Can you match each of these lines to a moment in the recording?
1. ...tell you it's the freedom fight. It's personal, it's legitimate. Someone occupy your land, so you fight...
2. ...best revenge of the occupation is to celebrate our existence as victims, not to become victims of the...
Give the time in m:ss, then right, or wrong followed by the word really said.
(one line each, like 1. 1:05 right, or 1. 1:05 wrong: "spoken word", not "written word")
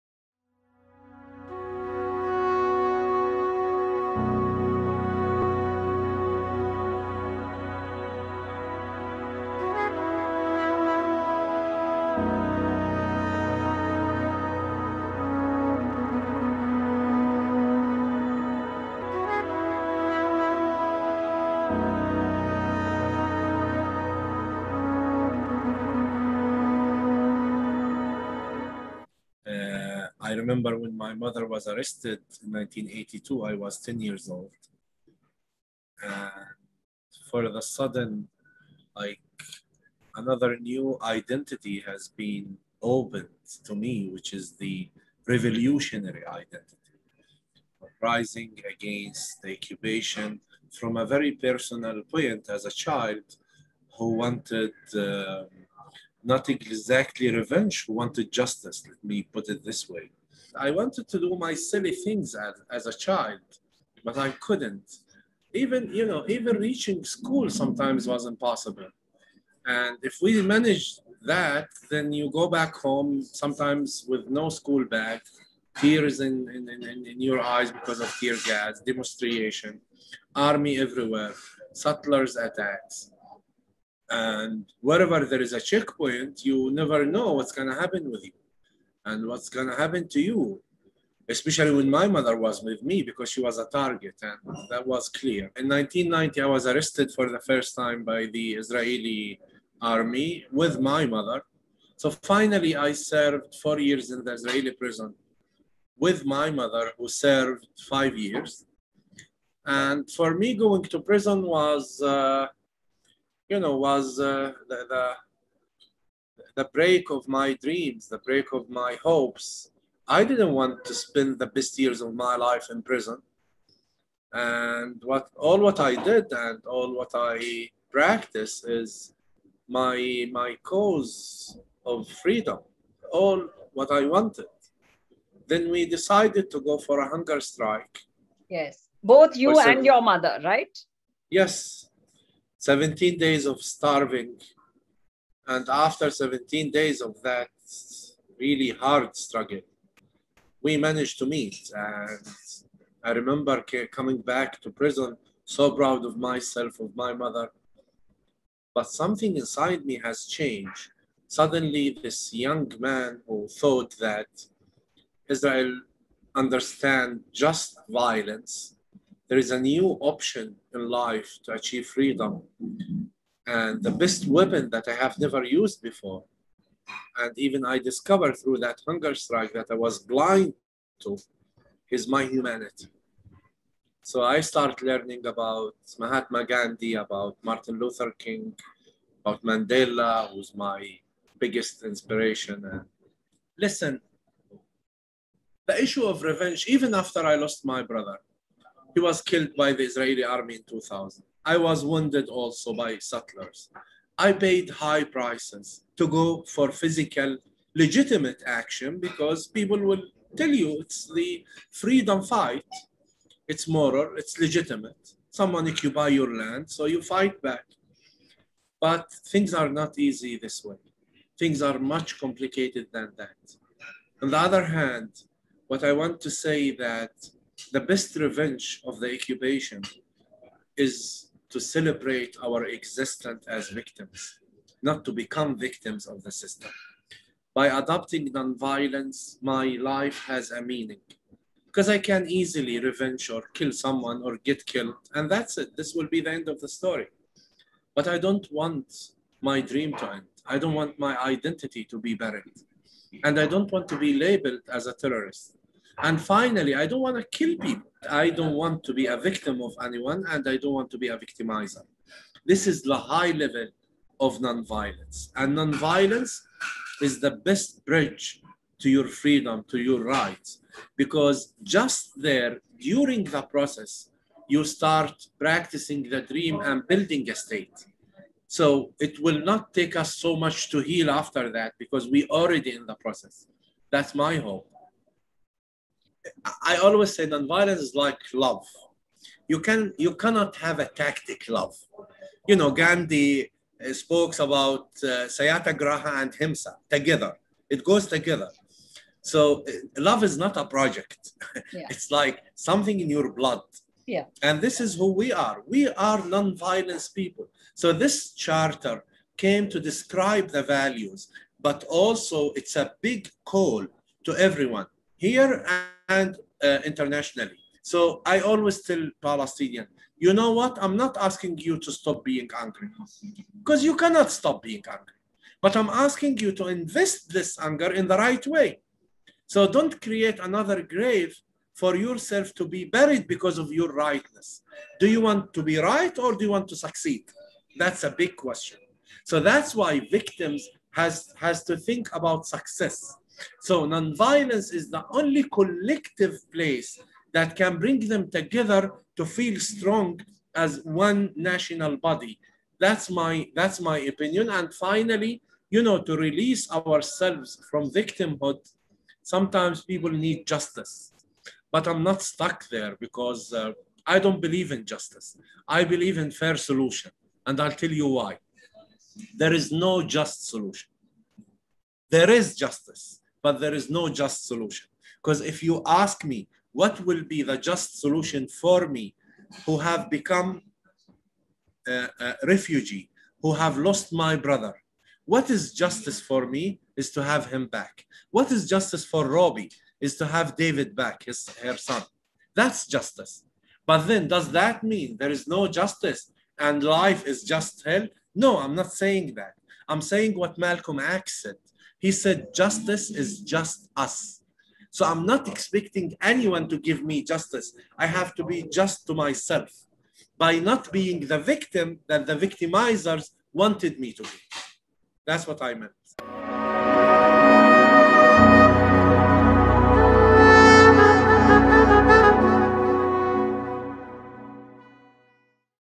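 1. 3:30 wrong: "moral", not "personal"
2. 3:47 right.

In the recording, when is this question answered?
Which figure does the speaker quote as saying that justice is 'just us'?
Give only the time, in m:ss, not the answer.
6:40.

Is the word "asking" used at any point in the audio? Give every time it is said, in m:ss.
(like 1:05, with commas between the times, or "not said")
5:21, 5:26.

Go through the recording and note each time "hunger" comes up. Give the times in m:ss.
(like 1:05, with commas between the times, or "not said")
2:17, 2:58.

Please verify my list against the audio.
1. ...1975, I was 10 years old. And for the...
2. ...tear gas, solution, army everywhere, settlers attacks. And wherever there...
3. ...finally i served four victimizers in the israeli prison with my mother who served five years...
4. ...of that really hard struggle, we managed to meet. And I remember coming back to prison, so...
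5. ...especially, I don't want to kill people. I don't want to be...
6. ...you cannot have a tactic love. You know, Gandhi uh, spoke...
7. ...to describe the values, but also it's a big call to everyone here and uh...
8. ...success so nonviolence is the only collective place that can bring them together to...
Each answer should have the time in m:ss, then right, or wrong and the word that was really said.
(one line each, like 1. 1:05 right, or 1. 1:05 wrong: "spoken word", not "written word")
1. 0:32 wrong: "1982", not "1975"
2. 1:18 wrong: "demonstration", not "solution"
3. 1:42 wrong: "years", not "victimizers"
4. 2:27 right
5. 4:16 wrong: "finally", not "especially"
6. 4:49 right
7. 5:09 right
8. 5:42 right.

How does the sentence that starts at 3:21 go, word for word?
I was wounded also by settlers.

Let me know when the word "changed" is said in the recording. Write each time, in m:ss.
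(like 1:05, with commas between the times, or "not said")
2:40.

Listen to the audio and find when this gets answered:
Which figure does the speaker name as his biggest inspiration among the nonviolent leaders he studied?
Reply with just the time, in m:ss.
3:09.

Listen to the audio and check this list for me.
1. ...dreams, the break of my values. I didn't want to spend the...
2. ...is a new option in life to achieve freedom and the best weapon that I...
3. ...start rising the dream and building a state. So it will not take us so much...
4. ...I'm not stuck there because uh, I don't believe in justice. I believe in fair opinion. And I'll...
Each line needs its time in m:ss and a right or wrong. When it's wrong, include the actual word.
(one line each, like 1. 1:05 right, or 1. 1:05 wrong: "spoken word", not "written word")
1. 1:57 wrong: "hopes", not "values"
2. 2:49 right
3. 4:34 wrong: "practicing", not "rising"
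4. 6:01 wrong: "solution", not "opinion".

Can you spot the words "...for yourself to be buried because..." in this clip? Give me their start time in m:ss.
5:31.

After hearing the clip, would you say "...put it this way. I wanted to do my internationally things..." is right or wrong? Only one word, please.
wrong.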